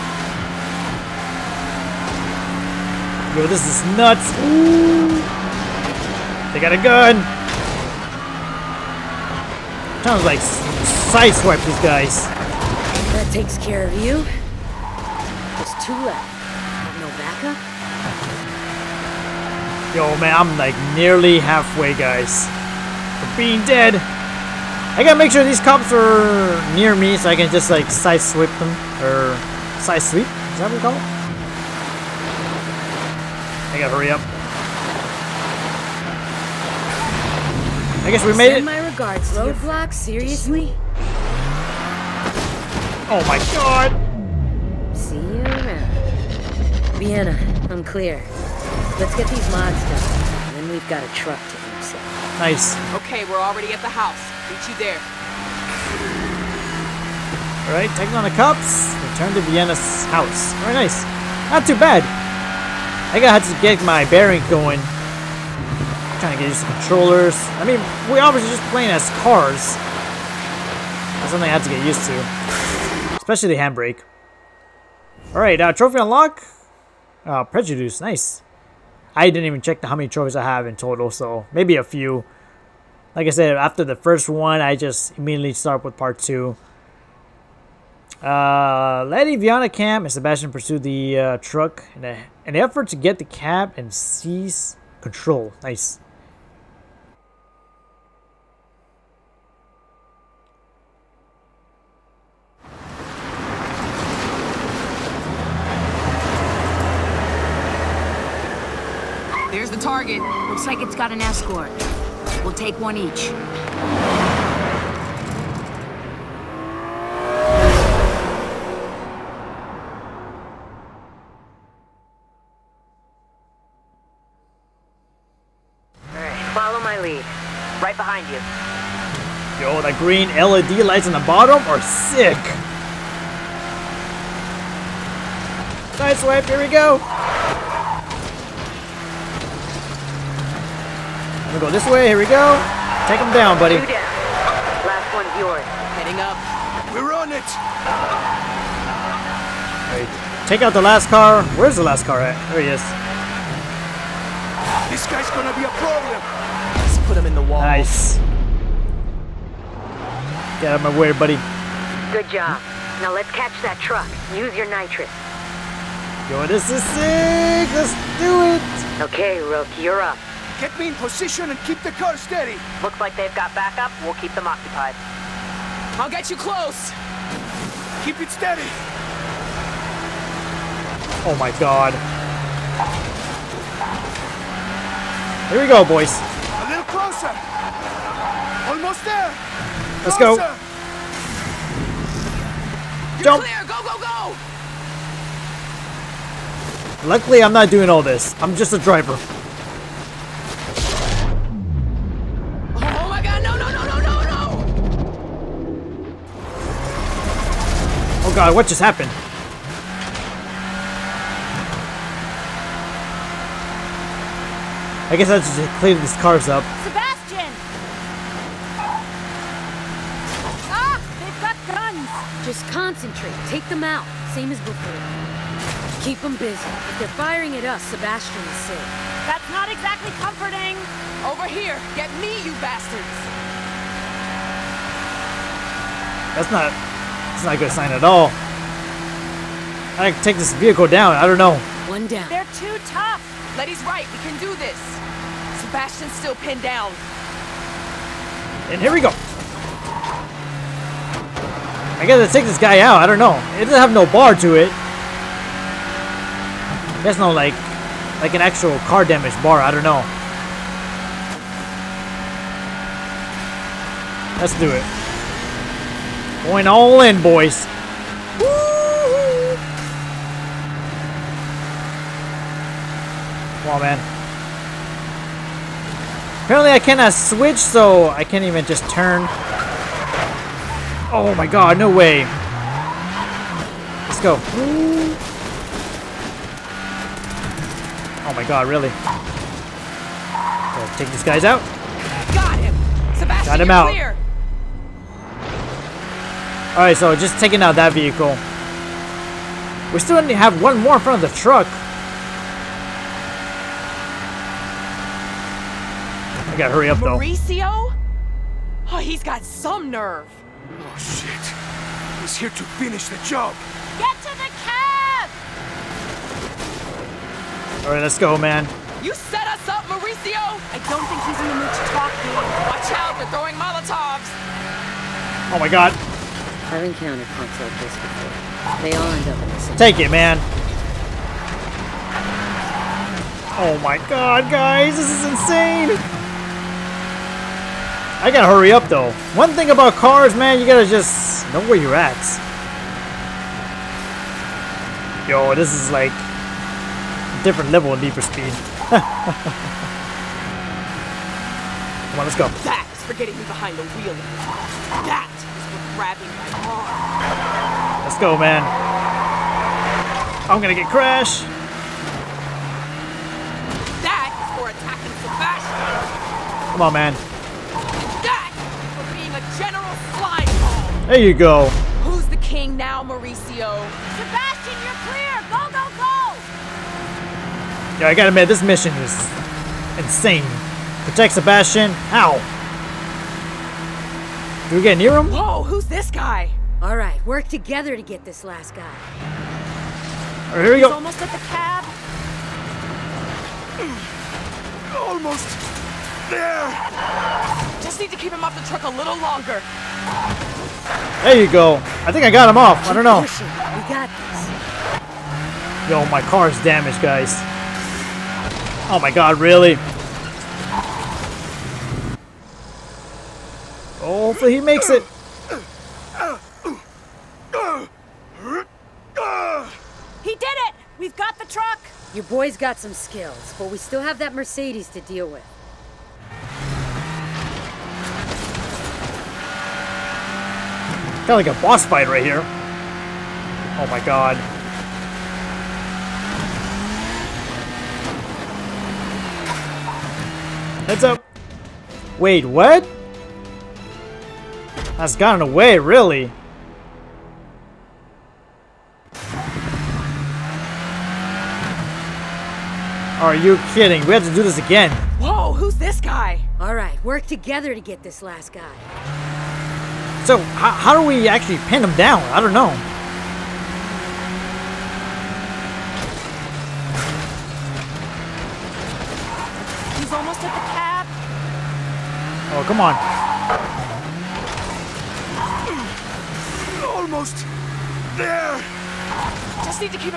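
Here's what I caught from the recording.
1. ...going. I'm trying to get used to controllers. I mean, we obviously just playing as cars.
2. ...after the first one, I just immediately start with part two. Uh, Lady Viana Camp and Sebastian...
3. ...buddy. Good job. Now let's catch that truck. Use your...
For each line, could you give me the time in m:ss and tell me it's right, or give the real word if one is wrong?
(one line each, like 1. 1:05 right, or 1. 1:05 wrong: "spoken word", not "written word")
1. 1:04 right
2. 1:23 right
3. 2:41 right.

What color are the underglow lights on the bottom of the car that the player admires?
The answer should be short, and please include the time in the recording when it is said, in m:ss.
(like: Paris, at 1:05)
Green, at 2:09.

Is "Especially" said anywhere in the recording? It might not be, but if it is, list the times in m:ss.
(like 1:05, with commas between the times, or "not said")
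1:13.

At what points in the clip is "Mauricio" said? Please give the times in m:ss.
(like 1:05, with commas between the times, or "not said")
5:07, 5:19, 6:13.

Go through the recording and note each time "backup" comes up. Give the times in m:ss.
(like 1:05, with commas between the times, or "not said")
0:17, 2:53.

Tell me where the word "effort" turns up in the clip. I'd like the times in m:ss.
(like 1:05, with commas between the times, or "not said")
1:32.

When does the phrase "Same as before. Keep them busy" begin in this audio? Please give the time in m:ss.
3:44.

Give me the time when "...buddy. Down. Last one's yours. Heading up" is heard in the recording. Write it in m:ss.
2:23.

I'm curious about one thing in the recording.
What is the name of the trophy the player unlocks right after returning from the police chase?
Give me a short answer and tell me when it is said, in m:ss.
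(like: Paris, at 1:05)
Prejudice, at 1:17.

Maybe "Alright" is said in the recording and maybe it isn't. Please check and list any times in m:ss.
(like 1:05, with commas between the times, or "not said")
0:57, 1:15.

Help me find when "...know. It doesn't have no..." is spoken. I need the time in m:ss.
4:13.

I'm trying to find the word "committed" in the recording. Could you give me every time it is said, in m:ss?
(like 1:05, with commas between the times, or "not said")
not said.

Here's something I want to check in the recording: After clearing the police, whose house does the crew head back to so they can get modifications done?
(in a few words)
Vienna's house.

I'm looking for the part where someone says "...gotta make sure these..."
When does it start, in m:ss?
0:25.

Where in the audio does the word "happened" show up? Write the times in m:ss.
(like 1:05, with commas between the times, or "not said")
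3:28.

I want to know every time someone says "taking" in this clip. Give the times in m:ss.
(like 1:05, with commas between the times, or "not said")
0:57, 4:57.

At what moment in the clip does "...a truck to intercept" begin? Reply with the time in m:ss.
0:51.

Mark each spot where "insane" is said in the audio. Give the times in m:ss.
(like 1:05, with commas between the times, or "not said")
5:35, 6:19.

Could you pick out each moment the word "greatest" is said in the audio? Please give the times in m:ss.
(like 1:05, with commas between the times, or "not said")
not said.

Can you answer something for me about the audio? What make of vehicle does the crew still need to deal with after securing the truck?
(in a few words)
Mercedes.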